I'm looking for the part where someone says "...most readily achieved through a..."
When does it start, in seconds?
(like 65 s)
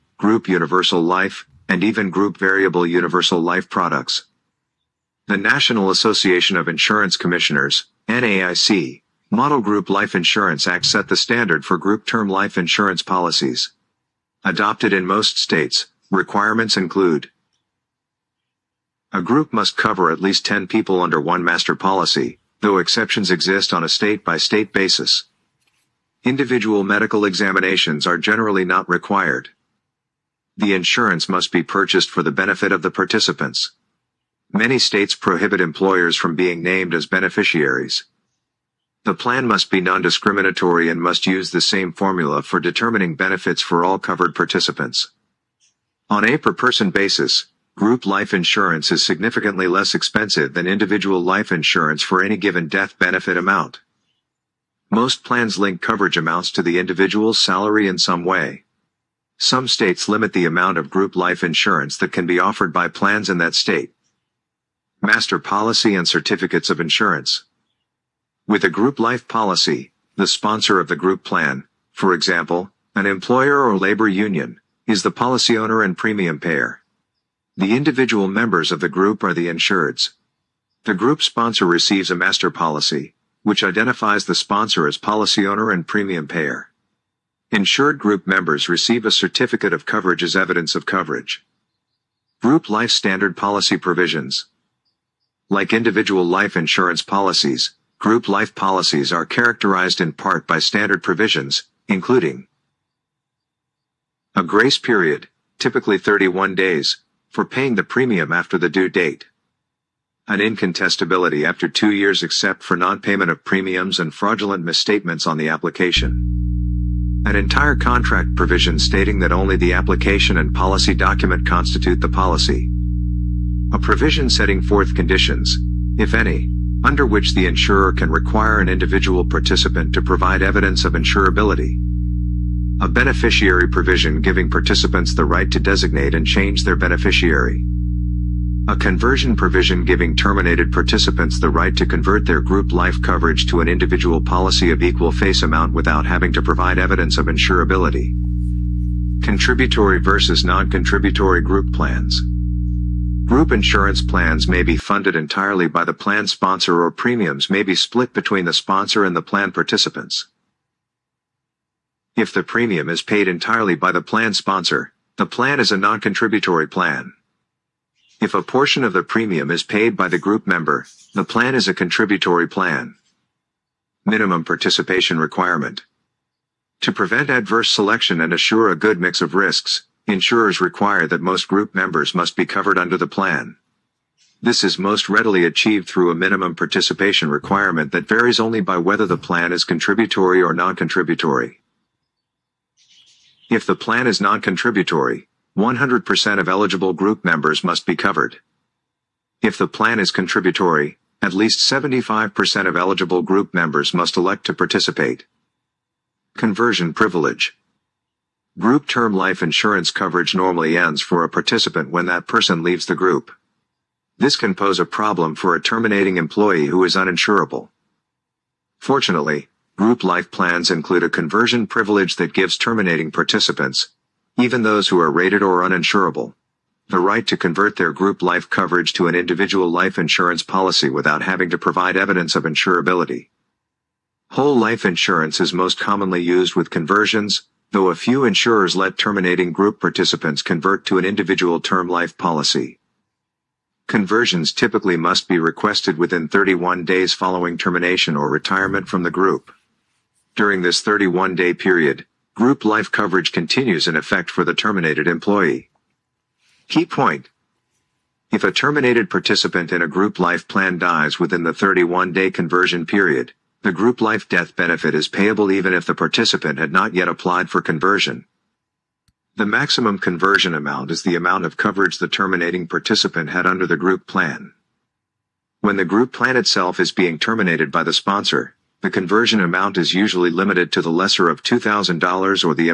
184 s.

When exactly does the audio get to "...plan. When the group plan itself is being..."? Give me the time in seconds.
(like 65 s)
274 s.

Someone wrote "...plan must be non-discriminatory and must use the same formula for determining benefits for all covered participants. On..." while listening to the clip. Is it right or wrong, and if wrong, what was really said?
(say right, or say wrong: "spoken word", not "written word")
right.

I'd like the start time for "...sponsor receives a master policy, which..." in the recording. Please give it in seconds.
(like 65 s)
81 s.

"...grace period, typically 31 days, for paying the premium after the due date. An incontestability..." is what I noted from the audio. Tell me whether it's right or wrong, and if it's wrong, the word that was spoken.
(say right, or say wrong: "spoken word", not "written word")
right.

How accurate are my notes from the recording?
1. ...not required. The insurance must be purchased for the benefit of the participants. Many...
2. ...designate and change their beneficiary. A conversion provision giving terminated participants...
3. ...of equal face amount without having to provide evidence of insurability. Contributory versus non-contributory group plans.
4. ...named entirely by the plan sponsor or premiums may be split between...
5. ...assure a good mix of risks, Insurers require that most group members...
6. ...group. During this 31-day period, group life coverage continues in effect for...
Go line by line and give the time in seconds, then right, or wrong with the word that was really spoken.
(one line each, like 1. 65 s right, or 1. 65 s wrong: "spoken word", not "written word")
1. 28 s right
2. 135 s right
3. 144 s right
4. 154 s wrong: "funded", not "named"
5. 178 s right
6. 249 s right.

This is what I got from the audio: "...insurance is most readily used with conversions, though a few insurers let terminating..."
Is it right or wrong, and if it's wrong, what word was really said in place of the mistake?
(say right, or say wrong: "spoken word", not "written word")
wrong: "commonly", not "readily".